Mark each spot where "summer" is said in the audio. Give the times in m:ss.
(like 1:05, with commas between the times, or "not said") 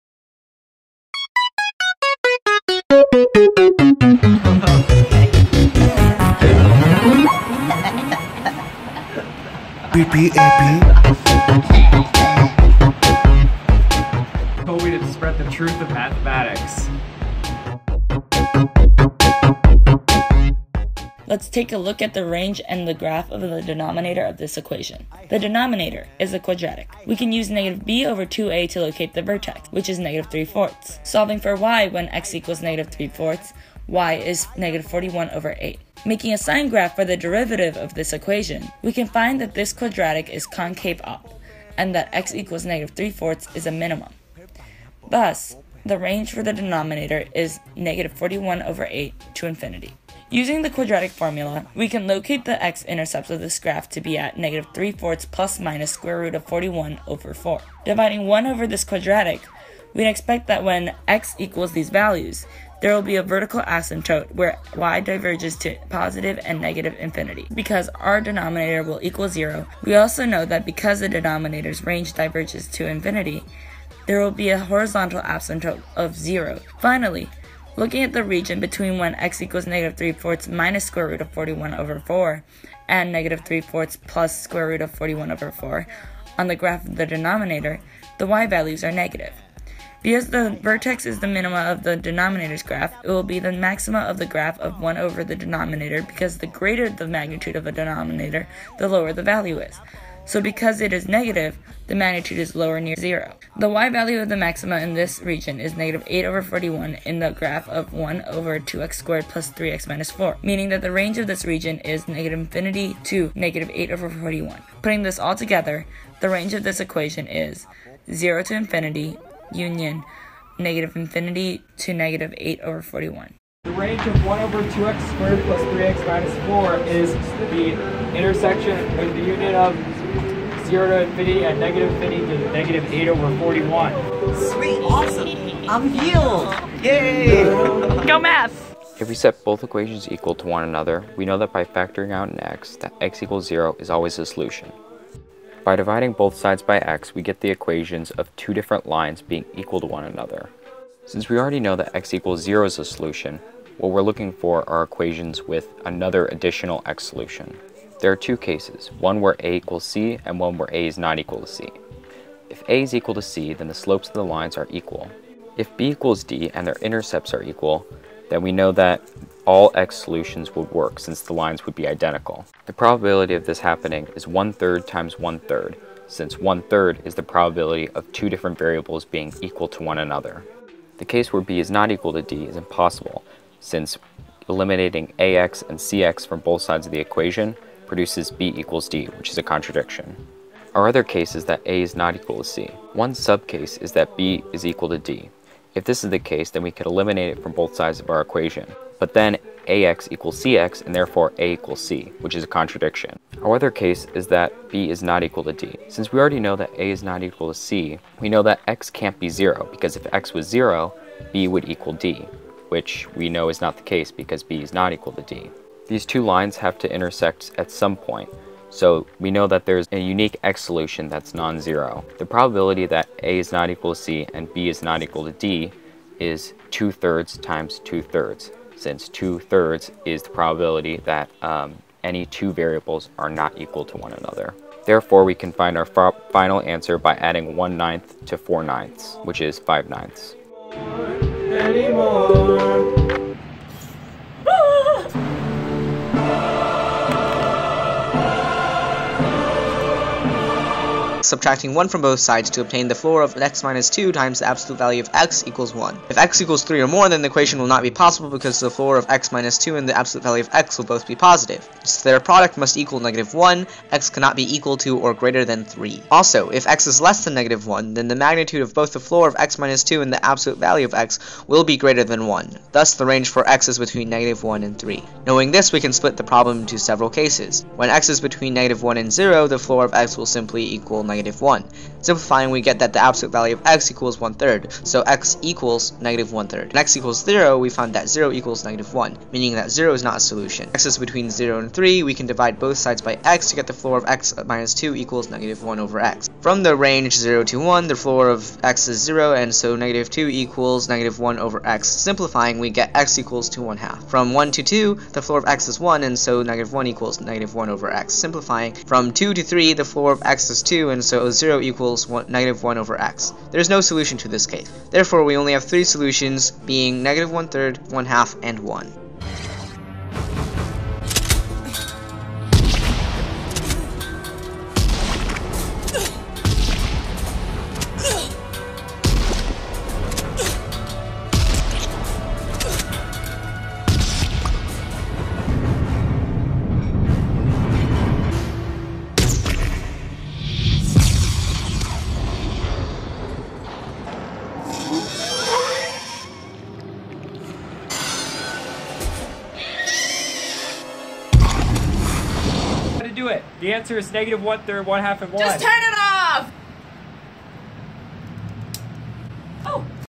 not said.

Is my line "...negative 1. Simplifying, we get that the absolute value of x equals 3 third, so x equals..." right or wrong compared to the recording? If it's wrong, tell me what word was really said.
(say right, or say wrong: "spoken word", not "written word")
wrong: "1", not "3".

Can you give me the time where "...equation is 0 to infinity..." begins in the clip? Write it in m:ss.
1:56.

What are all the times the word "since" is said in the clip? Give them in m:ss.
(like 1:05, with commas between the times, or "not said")
2:31, 2:50, 2:56, 3:03, 3:25, 3:48.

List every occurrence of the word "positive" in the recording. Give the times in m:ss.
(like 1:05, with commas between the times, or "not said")
1:05, 4:21.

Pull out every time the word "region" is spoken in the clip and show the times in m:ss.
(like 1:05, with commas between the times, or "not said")
1:18, 1:45, 1:51.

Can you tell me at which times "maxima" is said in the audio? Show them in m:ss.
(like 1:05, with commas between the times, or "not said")
1:33, 1:44.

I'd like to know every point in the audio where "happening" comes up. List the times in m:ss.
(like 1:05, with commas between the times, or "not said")
2:53.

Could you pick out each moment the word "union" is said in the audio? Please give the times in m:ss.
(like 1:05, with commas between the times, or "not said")
1:59, 2:09.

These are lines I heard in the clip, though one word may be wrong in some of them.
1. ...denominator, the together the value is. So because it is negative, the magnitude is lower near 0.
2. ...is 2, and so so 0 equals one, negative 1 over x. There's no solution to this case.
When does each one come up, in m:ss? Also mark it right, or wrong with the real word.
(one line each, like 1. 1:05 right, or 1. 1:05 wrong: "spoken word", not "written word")
1. 1:37 wrong: "lower", not "together"
2. 5:10 right.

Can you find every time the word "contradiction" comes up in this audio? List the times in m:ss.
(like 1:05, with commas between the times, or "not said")
3:09, 3:22.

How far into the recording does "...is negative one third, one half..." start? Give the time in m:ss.
5:53.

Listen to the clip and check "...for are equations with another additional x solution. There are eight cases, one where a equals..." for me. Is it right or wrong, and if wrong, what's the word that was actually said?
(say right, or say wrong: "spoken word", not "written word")
wrong: "two", not "eight".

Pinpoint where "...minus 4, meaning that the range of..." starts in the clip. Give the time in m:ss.
1:49.